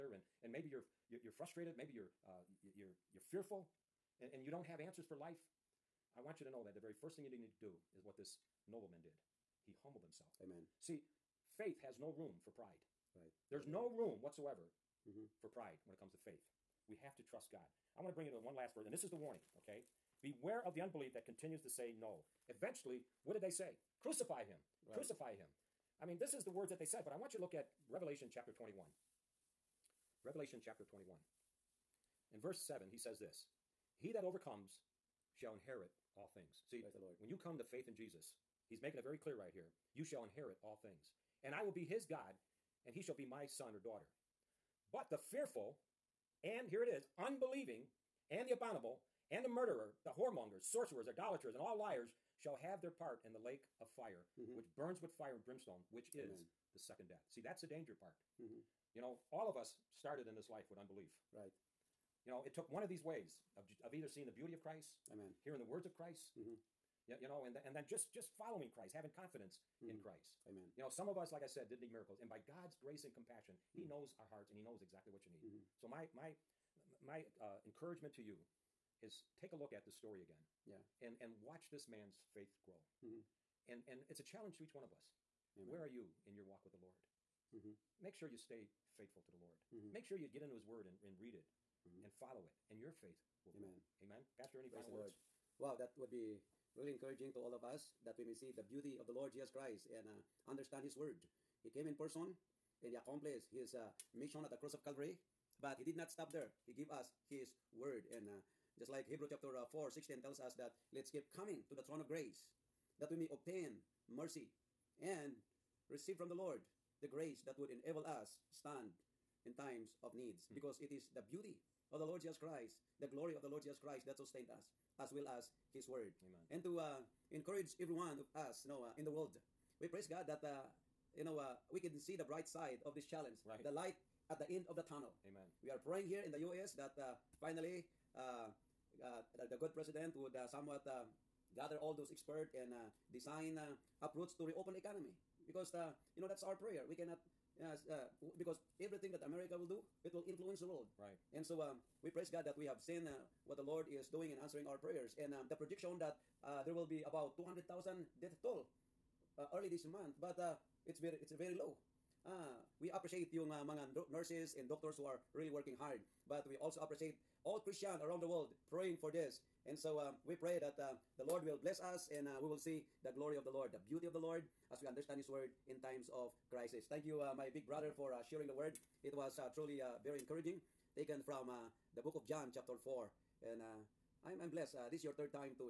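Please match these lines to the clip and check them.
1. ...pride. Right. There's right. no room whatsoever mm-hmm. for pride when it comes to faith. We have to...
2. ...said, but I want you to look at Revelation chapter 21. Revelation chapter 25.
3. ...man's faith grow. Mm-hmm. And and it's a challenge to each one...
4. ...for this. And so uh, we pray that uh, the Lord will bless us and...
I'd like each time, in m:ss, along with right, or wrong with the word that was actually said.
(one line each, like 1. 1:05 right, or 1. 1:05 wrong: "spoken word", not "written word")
1. 0:12 right
2. 0:26 wrong: "21", not "25"
3. 1:21 right
4. 2:48 right.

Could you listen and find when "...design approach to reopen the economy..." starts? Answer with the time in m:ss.
2:23.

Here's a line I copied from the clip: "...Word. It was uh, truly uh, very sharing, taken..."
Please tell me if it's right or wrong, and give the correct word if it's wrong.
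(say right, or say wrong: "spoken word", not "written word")
wrong: "encouraging", not "sharing".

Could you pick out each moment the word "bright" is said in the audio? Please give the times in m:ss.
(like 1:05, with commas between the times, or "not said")
2:12.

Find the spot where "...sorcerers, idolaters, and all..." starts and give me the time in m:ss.
0:50.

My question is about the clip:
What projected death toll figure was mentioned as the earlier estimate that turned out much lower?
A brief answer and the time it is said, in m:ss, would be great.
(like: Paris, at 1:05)
200,000, at 2:37.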